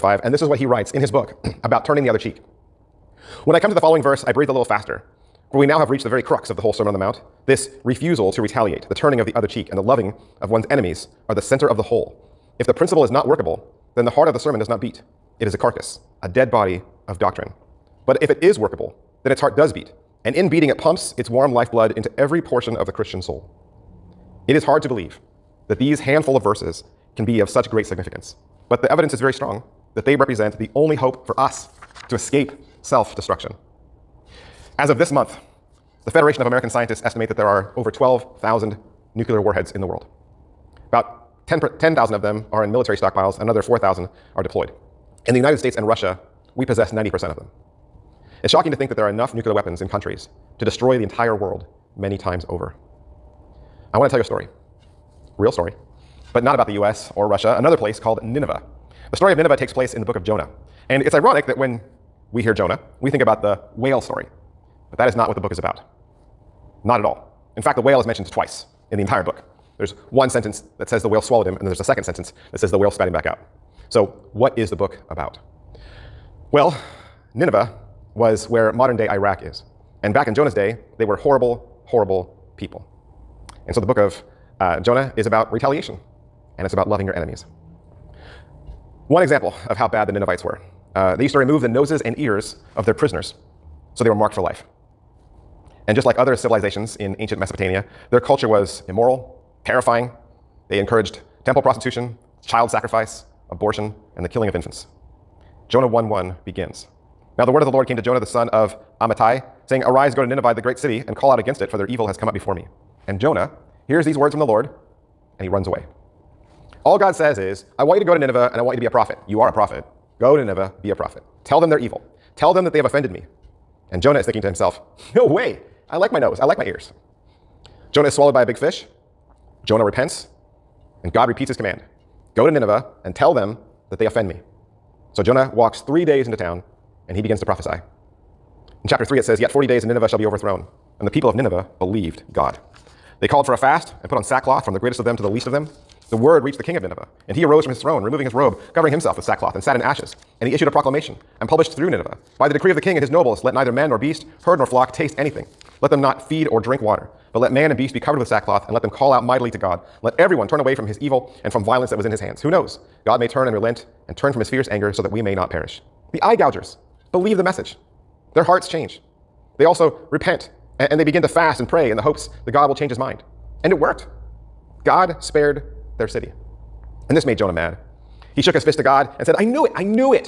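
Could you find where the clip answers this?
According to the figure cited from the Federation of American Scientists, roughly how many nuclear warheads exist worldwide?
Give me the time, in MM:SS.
00:37.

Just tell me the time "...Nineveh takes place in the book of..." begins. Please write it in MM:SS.
00:59.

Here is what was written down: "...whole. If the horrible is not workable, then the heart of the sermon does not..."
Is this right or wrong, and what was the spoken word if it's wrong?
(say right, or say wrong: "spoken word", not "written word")
wrong: "principle", not "horrible".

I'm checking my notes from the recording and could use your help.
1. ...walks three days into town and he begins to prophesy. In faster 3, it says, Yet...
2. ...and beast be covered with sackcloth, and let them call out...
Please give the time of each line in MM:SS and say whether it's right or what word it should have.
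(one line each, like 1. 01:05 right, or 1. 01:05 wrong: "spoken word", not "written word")
1. 02:15 wrong: "chapter", not "faster"
2. 02:37 right.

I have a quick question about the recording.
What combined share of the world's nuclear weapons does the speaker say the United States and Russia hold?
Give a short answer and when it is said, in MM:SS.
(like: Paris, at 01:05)
90%, at 00:46.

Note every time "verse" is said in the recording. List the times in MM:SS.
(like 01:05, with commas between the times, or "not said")
00:04, 00:26.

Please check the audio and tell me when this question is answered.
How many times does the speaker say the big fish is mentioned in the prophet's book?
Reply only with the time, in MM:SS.
01:08.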